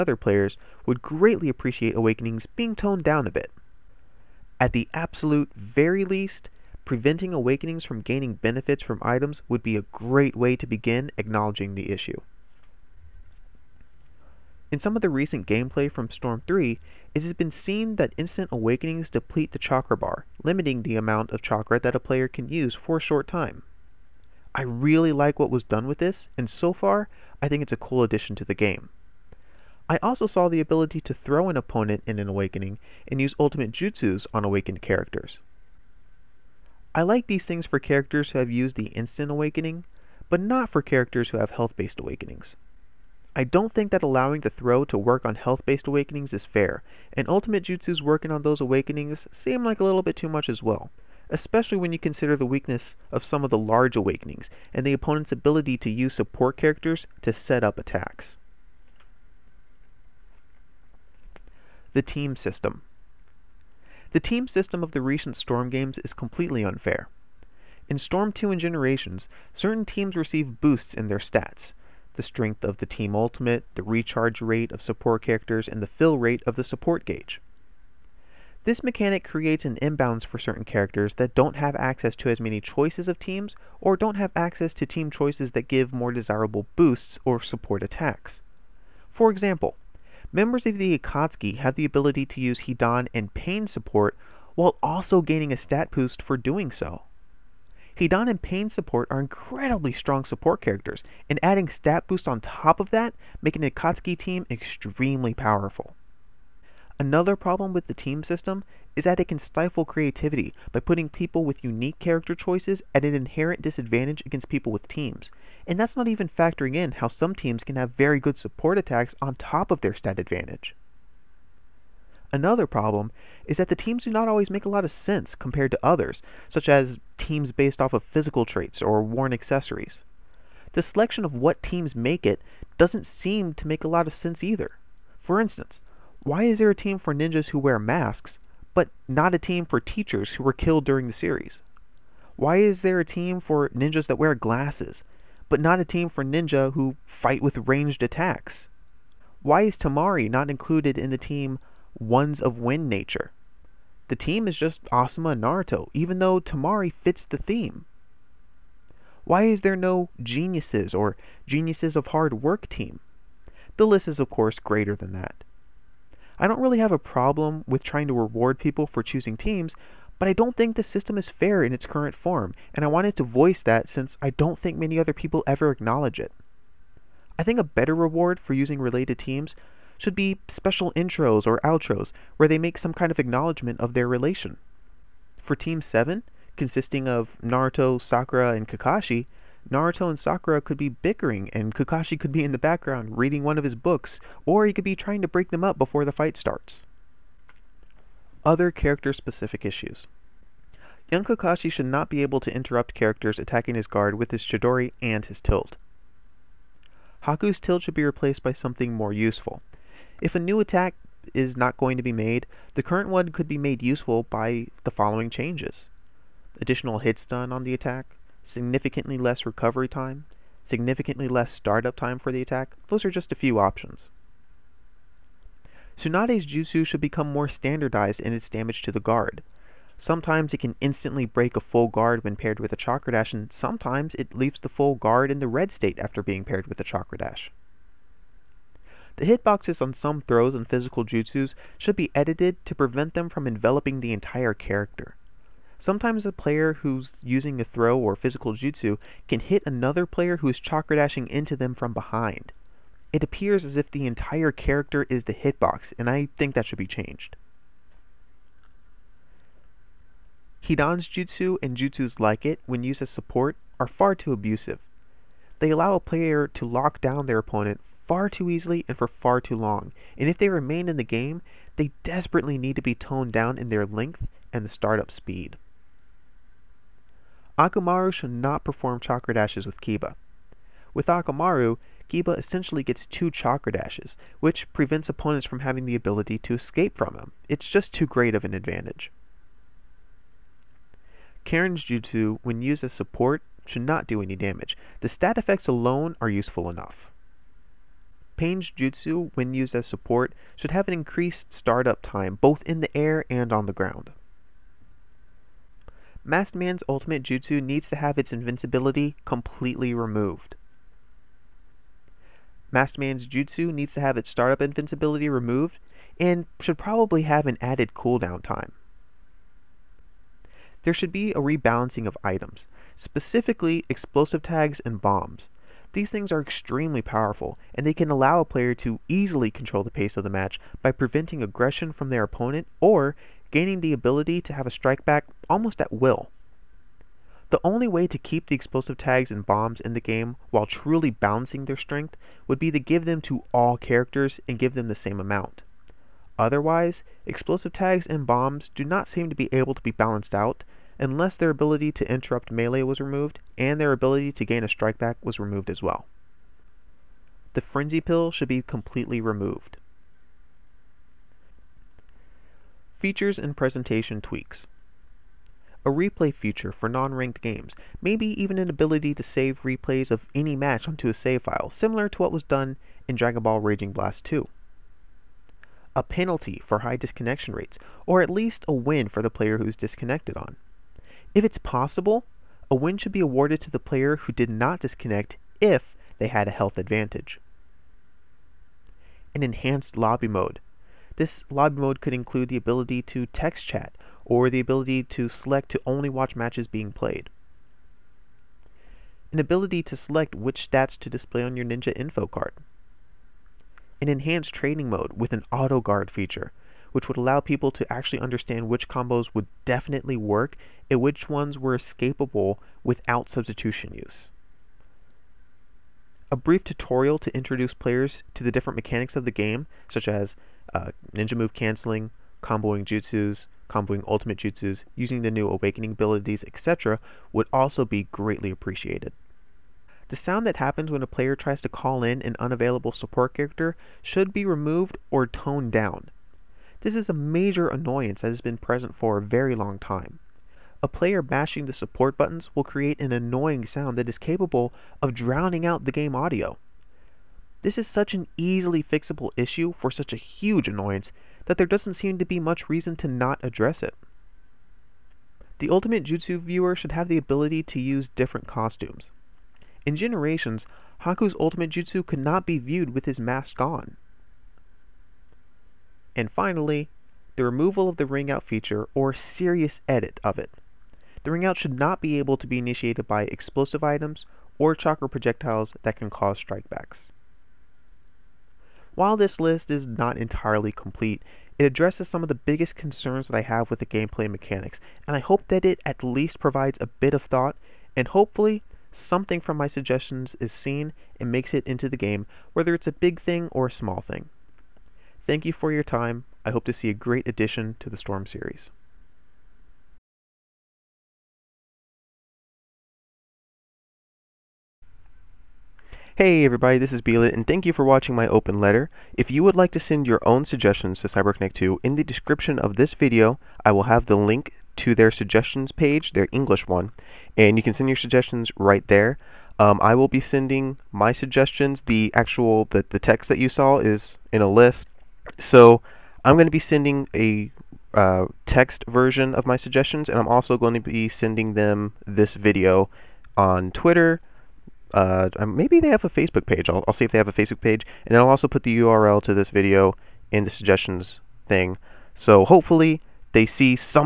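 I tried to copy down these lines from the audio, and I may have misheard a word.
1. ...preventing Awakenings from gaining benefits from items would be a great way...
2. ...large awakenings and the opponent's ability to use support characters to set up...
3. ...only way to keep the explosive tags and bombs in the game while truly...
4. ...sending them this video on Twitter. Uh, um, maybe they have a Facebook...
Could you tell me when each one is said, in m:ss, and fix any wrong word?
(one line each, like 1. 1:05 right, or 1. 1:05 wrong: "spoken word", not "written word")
1. 0:06 right
2. 0:53 right
3. 5:37 right
4. 8:51 right.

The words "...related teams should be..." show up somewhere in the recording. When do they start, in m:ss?
2:58.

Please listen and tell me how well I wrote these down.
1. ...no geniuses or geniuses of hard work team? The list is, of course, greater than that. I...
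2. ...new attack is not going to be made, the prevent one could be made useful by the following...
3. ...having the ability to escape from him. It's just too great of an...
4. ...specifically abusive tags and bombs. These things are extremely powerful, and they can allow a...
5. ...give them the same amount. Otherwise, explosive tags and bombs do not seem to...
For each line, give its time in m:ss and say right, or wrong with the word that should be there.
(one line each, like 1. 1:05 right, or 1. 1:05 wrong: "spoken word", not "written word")
1. 2:39 right
2. 3:30 wrong: "current", not "prevent"
3. 4:45 right
4. 5:22 wrong: "explosive", not "abusive"
5. 5:44 right.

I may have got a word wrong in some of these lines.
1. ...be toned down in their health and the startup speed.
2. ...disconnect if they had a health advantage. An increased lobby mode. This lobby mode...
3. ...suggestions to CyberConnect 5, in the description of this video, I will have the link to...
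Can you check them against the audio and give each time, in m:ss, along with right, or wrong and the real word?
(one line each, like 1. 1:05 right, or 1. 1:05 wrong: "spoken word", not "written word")
1. 4:32 wrong: "length", not "health"
2. 6:24 wrong: "enhanced", not "increased"
3. 8:30 wrong: "2", not "5".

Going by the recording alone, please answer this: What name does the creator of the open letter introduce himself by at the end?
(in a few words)
B-Lit.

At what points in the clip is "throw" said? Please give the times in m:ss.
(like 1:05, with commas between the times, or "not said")
0:31, 0:44, 4:00, 4:07.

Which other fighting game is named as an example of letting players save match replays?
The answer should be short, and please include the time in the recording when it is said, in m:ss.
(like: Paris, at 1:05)
Dragon Ball Raging Blast 2, at 6:13.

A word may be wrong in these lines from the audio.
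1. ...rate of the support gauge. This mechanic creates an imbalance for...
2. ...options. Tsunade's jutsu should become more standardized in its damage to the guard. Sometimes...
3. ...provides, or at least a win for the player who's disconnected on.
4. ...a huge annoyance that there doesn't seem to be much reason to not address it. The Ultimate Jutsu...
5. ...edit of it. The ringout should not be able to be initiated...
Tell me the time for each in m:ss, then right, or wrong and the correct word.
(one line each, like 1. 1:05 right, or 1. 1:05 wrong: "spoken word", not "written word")
1. 1:16 right
2. 3:43 right
3. 6:17 wrong: "rates", not "provides"
4. 7:30 right
5. 7:49 right.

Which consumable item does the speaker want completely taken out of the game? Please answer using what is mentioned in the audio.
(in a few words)
The frenzy pill.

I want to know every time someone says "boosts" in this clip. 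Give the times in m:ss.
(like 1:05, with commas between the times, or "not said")
1:10, 1:26, 1:35, 1:42.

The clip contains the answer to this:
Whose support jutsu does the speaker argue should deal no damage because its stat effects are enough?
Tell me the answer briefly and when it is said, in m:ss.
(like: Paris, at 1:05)
Karin, at 4:51.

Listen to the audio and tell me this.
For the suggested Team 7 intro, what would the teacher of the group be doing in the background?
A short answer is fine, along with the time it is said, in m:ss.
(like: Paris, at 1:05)
Reading one of his books, at 3:13.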